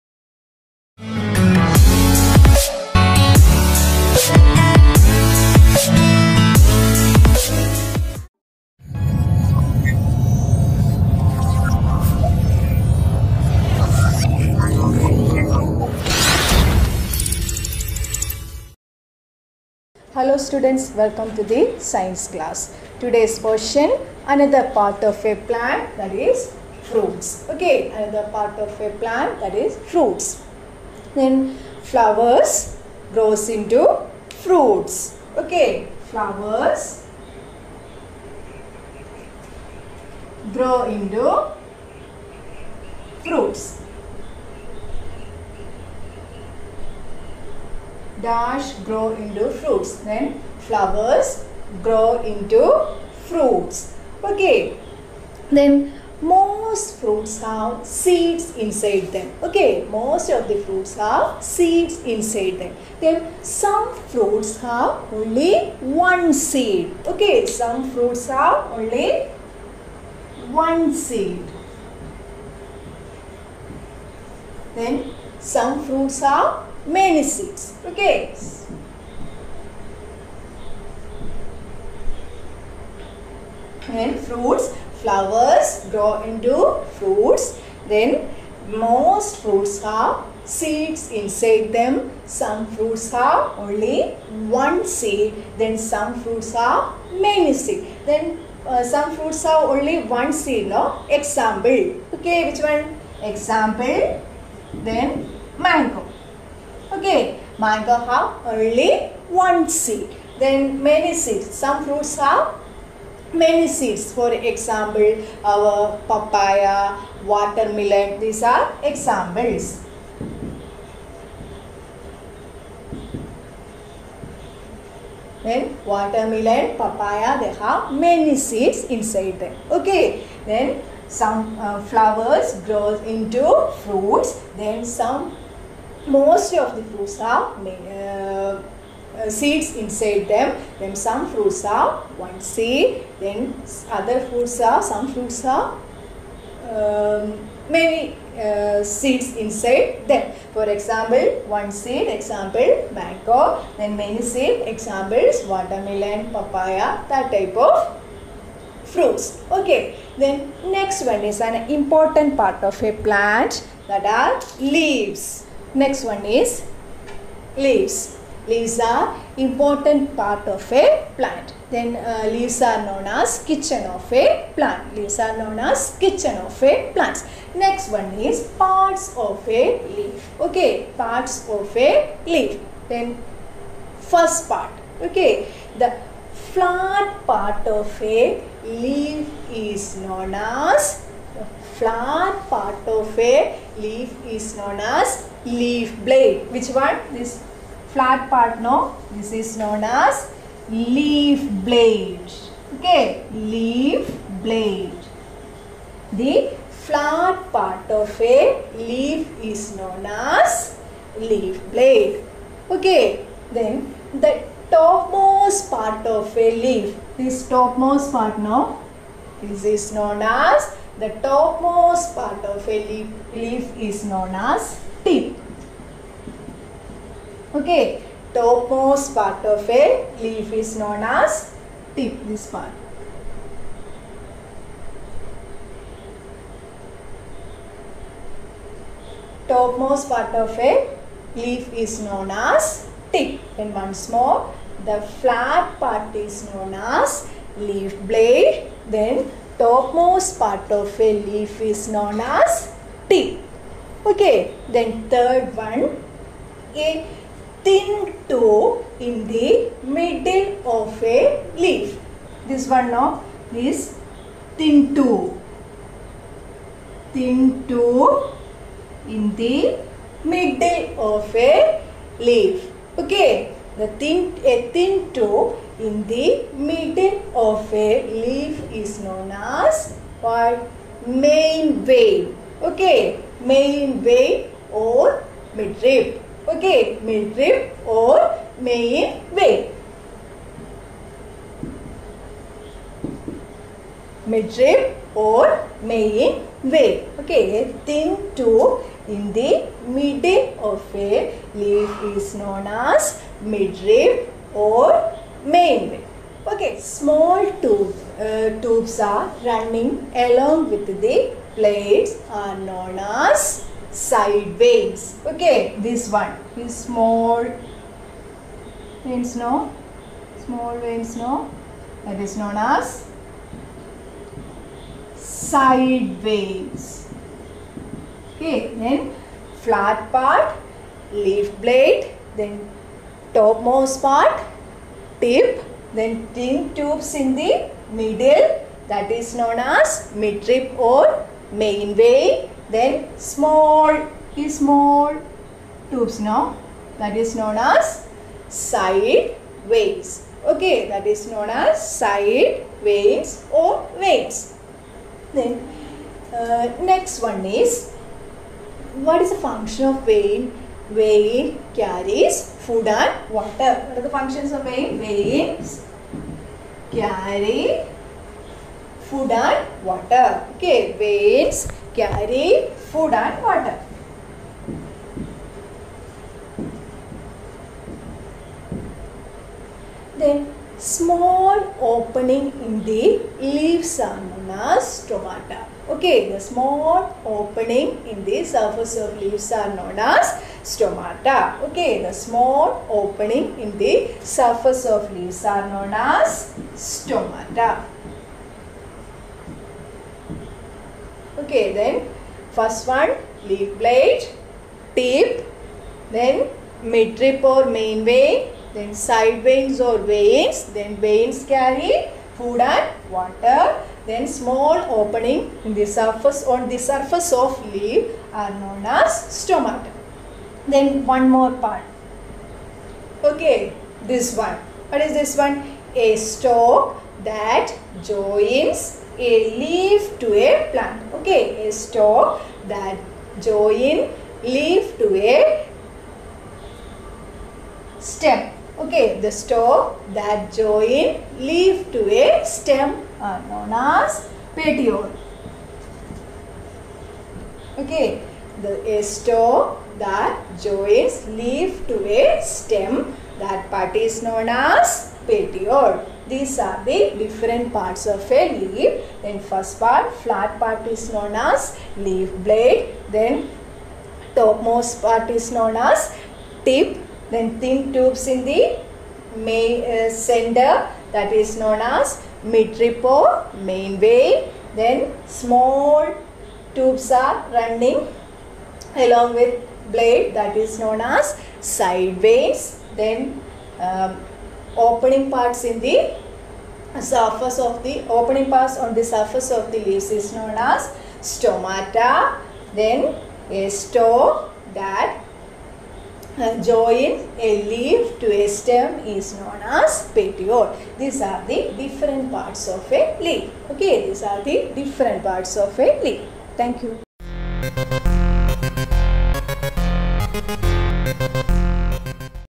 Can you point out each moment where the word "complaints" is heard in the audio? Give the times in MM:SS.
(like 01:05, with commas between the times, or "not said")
not said.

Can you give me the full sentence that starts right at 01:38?
Then uh, some fruits have only one seed.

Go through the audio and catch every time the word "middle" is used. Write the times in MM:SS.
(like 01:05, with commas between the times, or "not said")
04:19, 04:30, 04:36, 04:59, 05:37.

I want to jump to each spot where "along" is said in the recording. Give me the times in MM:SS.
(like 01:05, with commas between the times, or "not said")
05:10, 07:59.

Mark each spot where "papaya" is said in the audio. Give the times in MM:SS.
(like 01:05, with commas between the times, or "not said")
01:56, 02:06, 02:36.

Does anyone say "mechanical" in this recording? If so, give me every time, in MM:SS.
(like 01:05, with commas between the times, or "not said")
not said.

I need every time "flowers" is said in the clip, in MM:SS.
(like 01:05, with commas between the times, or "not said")
00:31, 00:36, 00:50, 01:25, 02:11.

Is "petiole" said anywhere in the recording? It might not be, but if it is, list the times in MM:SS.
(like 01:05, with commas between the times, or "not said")
07:24, 07:35, 08:20.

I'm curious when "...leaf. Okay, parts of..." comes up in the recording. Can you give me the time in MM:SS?
02:59.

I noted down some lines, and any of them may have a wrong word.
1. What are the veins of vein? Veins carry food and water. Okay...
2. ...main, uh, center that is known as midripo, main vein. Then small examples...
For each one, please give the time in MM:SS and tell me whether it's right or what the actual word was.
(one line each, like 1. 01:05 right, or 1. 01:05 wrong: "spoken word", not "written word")
1. 06:03 wrong: "functions", not "veins"
2. 07:49 wrong: "tubes", not "examples".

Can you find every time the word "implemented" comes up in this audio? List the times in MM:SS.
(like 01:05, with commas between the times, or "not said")
not said.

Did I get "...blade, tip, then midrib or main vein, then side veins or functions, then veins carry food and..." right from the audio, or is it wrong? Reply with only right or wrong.
wrong.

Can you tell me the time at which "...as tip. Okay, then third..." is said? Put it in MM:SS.
04:12.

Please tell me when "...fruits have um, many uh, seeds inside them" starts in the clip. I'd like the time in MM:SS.
02:25.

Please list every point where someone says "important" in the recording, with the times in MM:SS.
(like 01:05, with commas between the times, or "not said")
02:41, 02:49.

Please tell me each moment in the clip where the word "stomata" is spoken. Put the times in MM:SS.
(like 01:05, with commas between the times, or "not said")
06:25, 06:30, 06:36, 06:59, 08:11.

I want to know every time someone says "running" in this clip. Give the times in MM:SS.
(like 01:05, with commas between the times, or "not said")
05:09, 07:57.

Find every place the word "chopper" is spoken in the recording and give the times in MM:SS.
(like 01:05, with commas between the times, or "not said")
not said.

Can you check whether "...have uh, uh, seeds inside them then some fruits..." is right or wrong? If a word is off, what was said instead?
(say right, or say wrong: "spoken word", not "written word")
right.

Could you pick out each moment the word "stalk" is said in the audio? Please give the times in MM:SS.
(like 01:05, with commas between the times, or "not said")
07:06, 07:11, 07:19, 08:13.